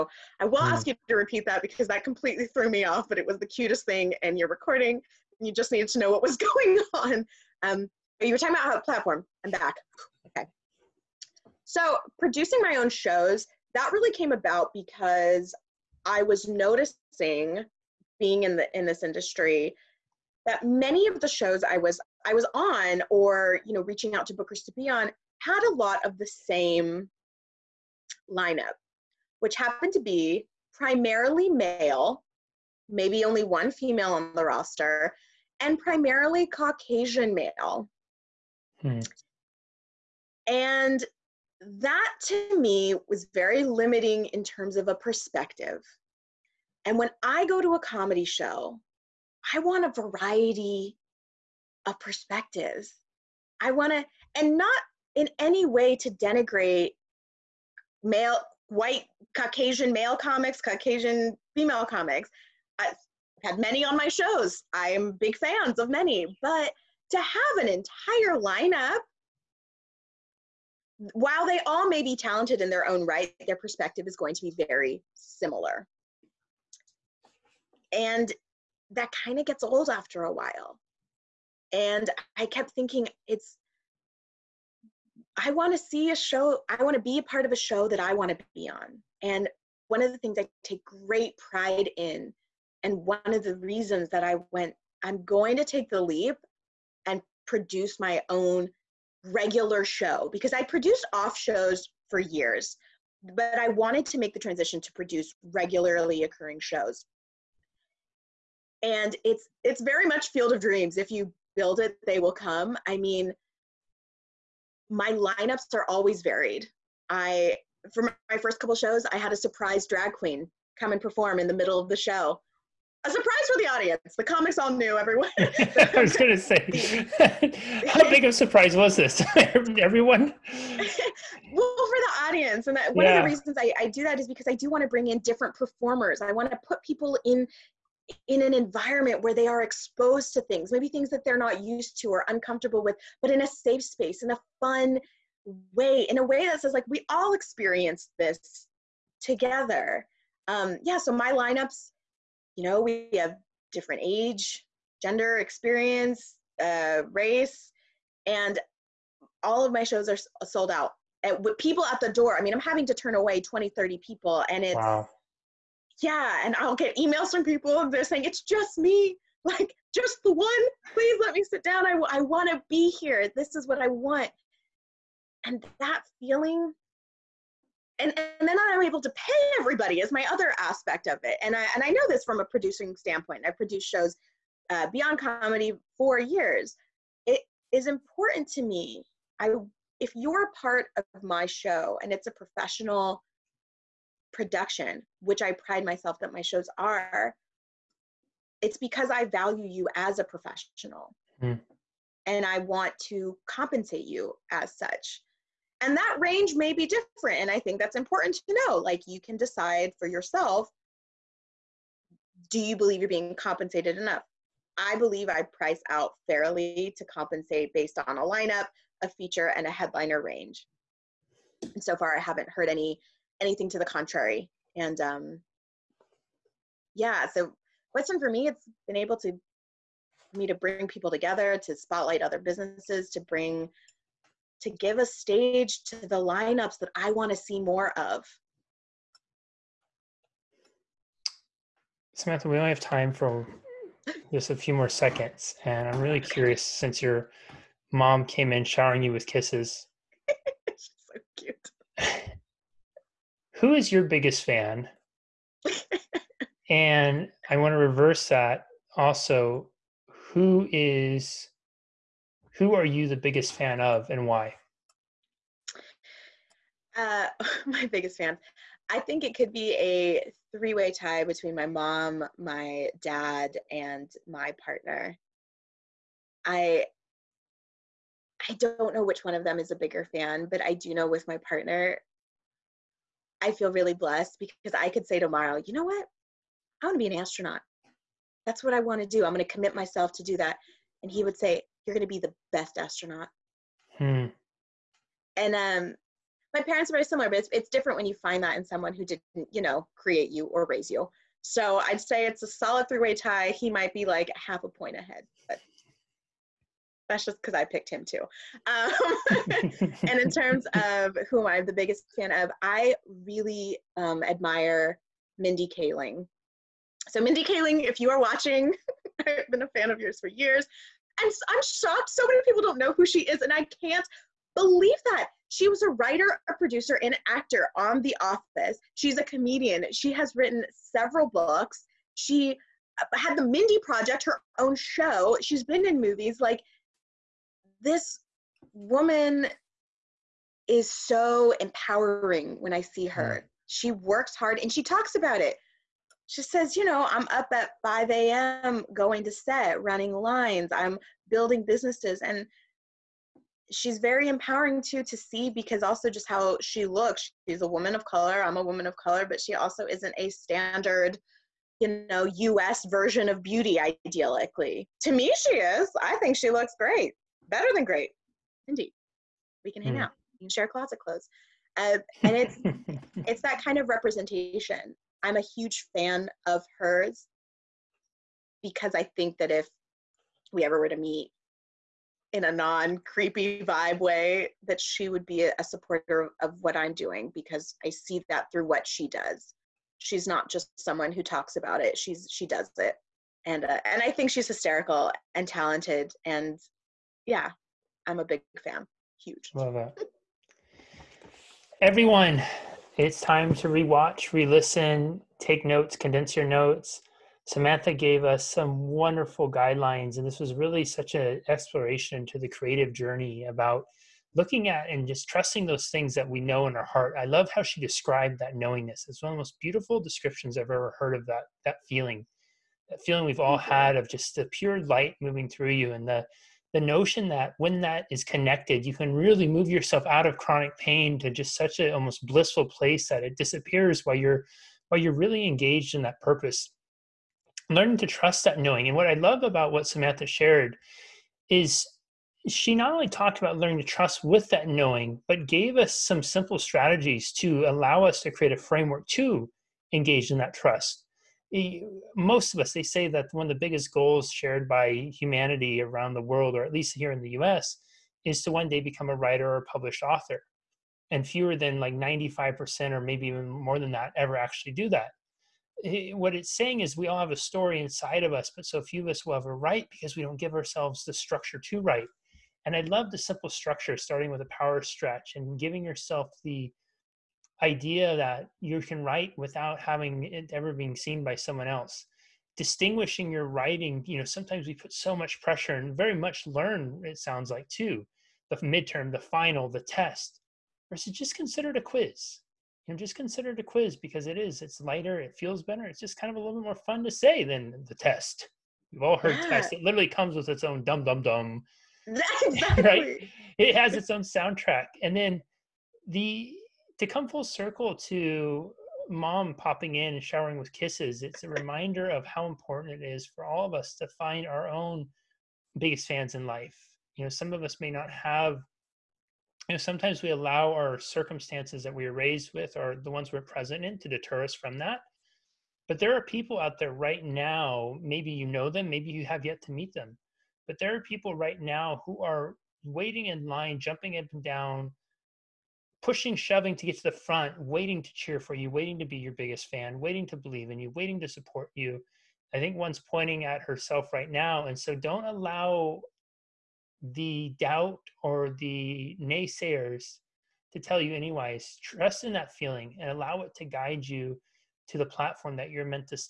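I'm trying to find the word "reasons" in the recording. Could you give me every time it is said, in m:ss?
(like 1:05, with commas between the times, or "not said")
1:33, 2:13.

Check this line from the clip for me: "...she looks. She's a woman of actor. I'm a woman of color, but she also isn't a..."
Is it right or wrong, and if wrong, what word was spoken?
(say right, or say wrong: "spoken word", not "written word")
wrong: "color", not "actor".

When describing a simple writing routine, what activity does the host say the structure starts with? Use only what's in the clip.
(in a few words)
Power stretch.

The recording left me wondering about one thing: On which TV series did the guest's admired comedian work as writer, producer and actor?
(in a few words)
The Office.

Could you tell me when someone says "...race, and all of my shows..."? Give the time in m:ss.
2:37.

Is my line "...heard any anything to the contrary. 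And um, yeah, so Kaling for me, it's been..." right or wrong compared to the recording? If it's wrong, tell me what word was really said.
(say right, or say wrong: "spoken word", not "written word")
wrong: "Western", not "Kaling".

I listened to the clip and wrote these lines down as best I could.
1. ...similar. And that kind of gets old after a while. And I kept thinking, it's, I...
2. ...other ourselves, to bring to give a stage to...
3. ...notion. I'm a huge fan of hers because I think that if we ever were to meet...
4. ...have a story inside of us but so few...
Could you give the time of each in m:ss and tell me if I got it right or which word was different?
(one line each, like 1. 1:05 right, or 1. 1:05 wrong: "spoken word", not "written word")
1. 1:15 right
2. 3:52 wrong: "businesses", not "ourselves"
3. 6:13 wrong: "representation", not "notion"
4. 7:47 right.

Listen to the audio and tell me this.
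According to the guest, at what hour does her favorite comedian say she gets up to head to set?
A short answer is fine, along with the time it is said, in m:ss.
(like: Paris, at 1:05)
5 a.m., at 5:47.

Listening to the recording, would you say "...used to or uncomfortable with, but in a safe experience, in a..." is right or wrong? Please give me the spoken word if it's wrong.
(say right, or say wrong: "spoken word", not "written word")
wrong: "space", not "experience".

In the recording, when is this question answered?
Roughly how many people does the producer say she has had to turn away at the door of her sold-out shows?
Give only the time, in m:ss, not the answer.
2:43.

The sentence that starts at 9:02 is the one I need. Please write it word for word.
I think one's pointing at herself right now.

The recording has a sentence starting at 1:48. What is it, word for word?
And it's it's very much field of dreams if you build it, they will come.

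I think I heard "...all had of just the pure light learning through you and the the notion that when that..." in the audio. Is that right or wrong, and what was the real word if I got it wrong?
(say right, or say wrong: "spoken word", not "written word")
wrong: "moving", not "learning".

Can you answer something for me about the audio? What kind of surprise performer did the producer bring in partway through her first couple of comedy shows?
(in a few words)
Drag queen.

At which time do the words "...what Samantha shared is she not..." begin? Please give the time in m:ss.
7:19.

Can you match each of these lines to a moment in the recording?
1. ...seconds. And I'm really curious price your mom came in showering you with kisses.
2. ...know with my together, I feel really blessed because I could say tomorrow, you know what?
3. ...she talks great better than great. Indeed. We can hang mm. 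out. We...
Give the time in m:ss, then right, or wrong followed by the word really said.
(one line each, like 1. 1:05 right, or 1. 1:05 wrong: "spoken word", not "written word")
1. 4:04 wrong: "since", not "price"
2. 4:40 wrong: "partner", not "together"
3. 6:06 wrong: "looks", not "talks".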